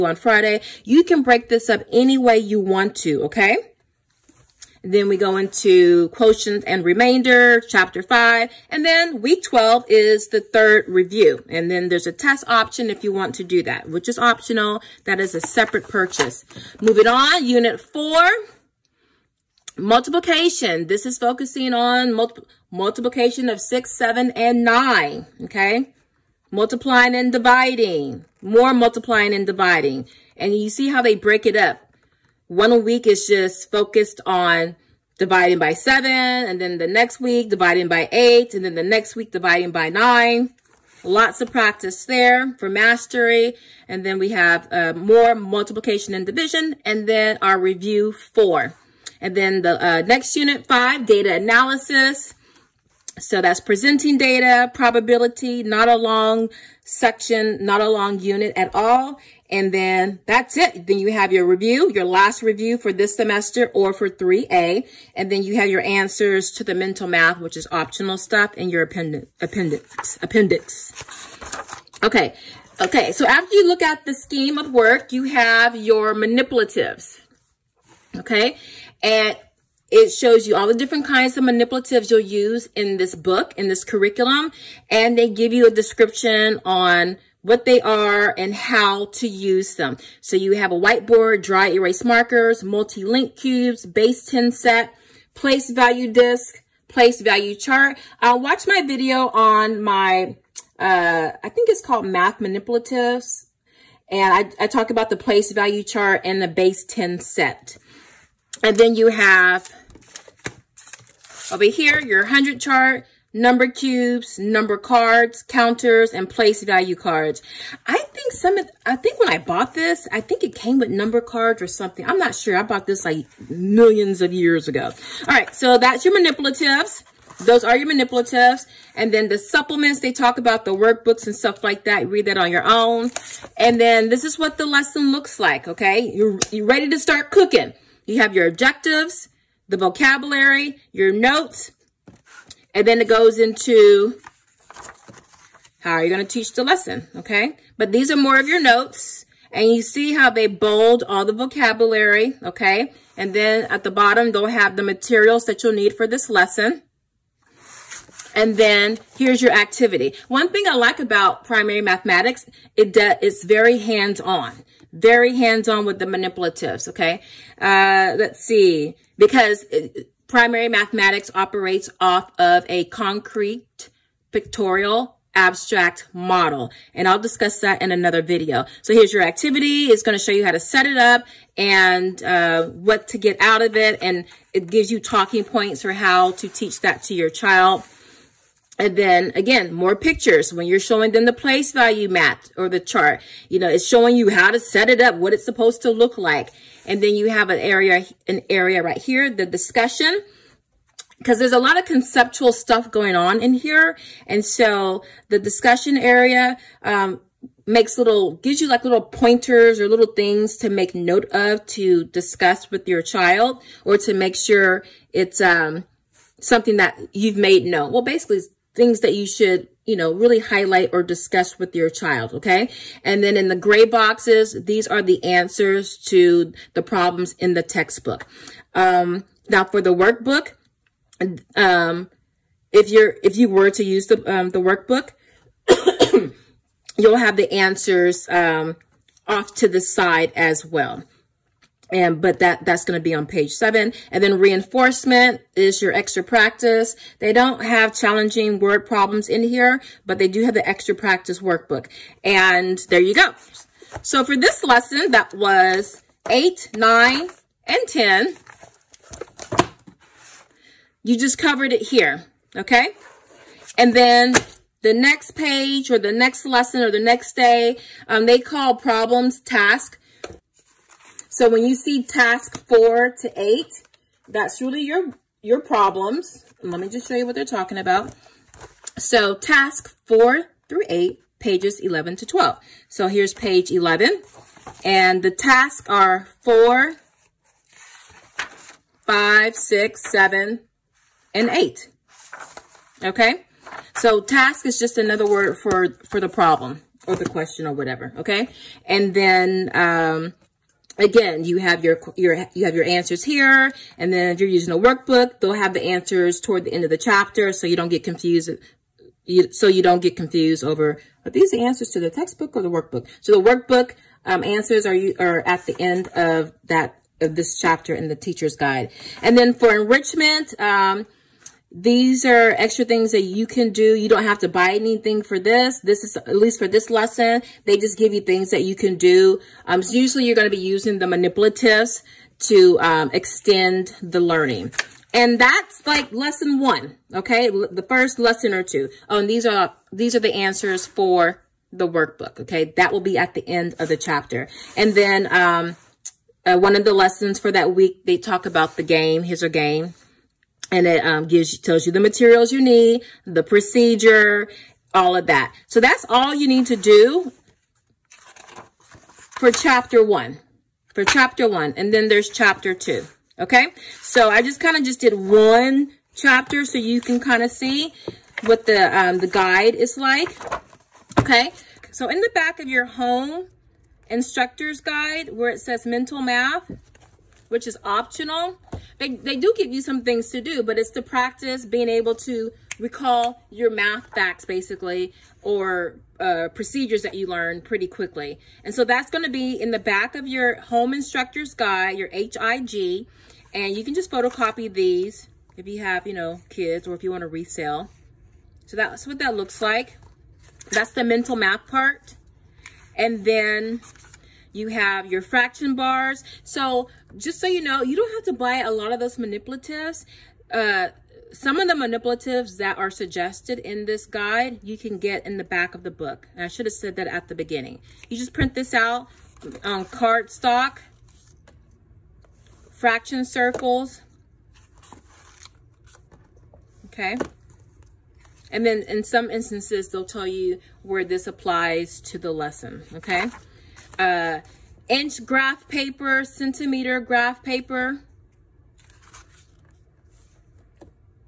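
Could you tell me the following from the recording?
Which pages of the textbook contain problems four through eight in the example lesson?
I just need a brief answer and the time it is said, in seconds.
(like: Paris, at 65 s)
11 to 12, at 281 s.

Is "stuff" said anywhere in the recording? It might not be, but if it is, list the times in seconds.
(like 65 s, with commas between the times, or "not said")
68 s, 131 s, 202 s.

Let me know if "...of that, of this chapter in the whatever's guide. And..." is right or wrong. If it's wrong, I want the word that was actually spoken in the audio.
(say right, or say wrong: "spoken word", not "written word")
wrong: "teacher", not "whatever".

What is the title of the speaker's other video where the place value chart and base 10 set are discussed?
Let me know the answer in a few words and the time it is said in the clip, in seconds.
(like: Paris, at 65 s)
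Math Manipulatives, at 102 s.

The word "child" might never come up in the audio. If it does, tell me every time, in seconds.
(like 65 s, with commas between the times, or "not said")
187 s, 213 s, 221 s.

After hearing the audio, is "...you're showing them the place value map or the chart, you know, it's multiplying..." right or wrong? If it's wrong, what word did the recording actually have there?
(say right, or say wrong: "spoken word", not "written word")
wrong: "showing", not "multiplying".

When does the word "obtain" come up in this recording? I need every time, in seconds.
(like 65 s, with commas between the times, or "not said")
not said.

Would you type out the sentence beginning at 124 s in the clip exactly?
All right, so that's your manipulatives.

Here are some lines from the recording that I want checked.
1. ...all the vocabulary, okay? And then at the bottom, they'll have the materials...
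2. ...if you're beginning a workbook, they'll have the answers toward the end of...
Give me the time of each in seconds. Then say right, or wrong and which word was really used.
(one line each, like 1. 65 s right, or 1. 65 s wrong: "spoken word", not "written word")
1. 151 s right
2. 304 s wrong: "using", not "beginning".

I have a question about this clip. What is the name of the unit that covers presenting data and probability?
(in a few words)
Data analysis.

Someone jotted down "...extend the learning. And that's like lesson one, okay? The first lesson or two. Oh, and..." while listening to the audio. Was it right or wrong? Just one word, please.
right.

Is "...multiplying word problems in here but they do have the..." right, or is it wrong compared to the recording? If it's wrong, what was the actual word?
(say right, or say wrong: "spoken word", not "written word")
wrong: "challenging", not "multiplying".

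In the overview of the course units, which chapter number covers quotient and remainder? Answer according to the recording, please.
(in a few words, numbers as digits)
5.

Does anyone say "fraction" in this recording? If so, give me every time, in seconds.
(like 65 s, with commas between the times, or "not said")
405 s, 422 s.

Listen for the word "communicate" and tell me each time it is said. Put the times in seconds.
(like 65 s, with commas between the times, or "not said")
not said.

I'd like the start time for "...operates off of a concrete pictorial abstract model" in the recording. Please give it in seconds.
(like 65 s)
171 s.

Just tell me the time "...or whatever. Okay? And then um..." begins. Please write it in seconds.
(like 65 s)
297 s.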